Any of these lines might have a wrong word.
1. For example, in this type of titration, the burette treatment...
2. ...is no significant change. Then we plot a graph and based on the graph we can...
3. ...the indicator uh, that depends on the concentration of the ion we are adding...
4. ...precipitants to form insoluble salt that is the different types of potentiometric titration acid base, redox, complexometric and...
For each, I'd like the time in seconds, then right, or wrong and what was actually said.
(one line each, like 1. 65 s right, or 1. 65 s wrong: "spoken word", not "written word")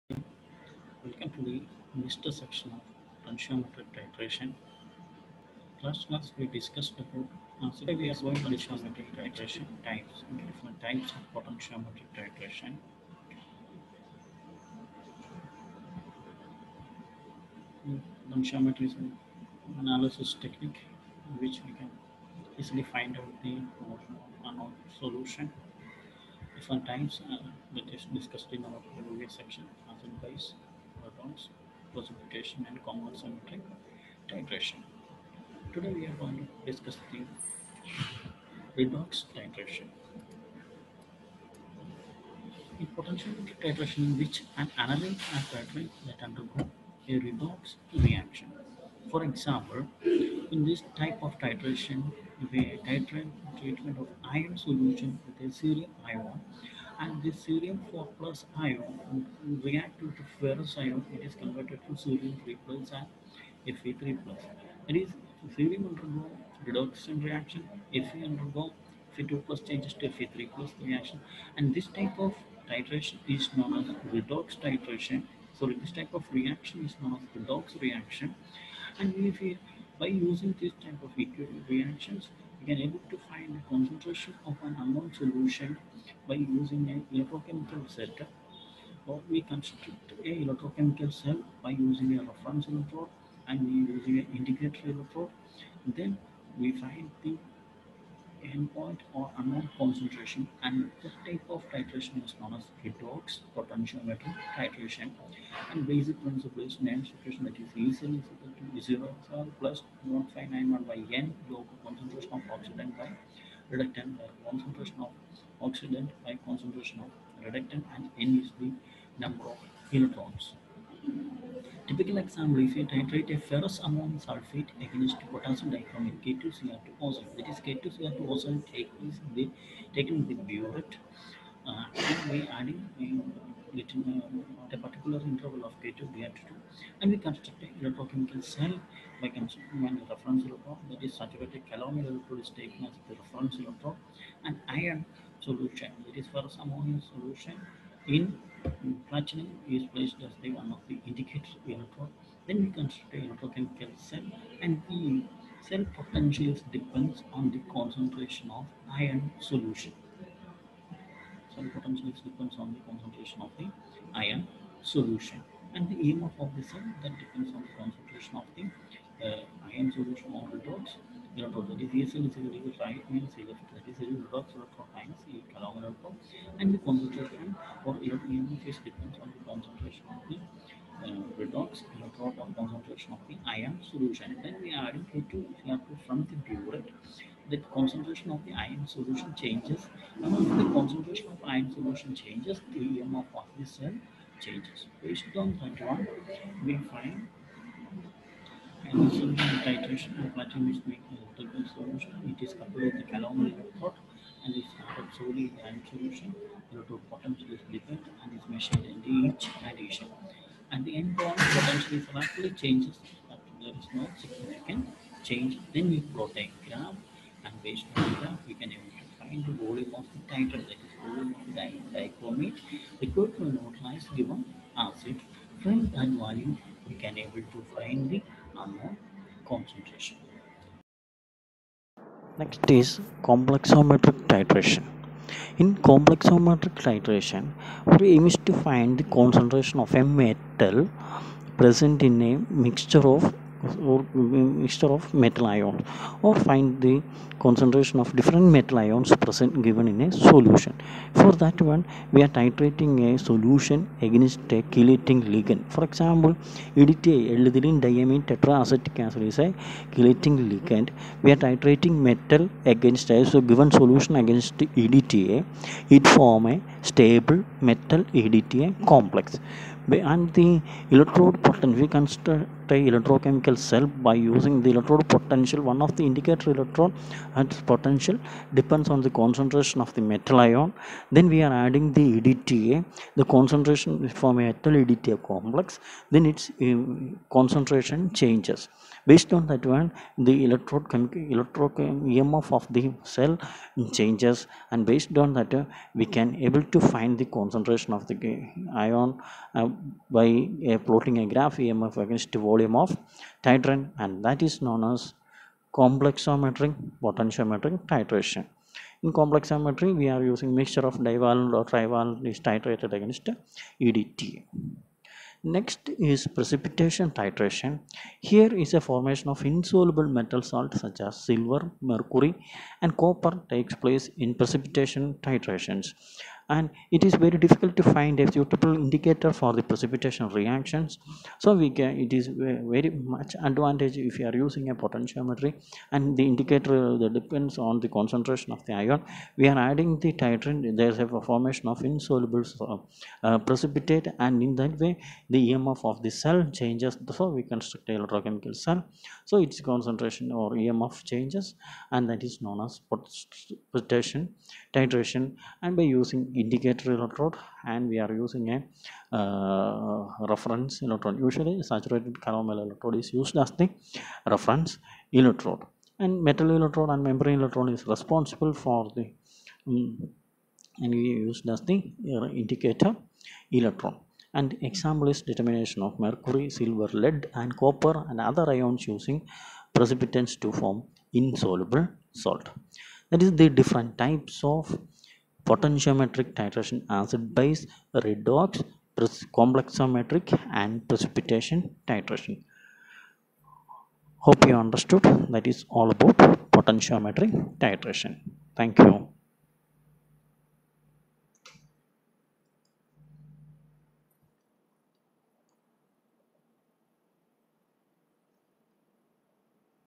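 1. 49 s wrong: "titrate", not "burette"
2. 213 s right
3. 336 s right
4. 379 s right.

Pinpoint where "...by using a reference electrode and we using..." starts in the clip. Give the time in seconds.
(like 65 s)
91 s.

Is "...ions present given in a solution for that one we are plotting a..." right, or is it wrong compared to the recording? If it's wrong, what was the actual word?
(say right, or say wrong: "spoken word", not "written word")
wrong: "titrating", not "plotting".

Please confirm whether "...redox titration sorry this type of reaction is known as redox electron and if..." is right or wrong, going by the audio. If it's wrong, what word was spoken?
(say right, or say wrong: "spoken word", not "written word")
wrong: "reaction", not "electron".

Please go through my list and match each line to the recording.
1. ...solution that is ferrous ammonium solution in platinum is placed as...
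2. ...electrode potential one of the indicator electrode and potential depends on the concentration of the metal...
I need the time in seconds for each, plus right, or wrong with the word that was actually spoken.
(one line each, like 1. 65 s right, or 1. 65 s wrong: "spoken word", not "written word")
1. 145 s right
2. 274 s right.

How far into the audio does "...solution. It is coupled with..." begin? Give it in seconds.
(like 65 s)
201 s.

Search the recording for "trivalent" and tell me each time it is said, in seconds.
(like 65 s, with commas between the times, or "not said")
311 s.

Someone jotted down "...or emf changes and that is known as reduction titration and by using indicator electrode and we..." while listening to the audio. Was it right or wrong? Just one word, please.
wrong.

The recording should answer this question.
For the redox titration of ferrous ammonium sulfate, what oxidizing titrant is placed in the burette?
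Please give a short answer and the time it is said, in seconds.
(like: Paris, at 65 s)
potassium dichromate, at 125 s.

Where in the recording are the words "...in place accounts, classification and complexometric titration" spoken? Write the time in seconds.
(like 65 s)
30 s.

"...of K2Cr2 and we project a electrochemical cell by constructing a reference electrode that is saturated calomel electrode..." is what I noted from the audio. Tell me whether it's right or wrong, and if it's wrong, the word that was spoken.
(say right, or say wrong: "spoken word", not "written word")
wrong: "construct", not "project".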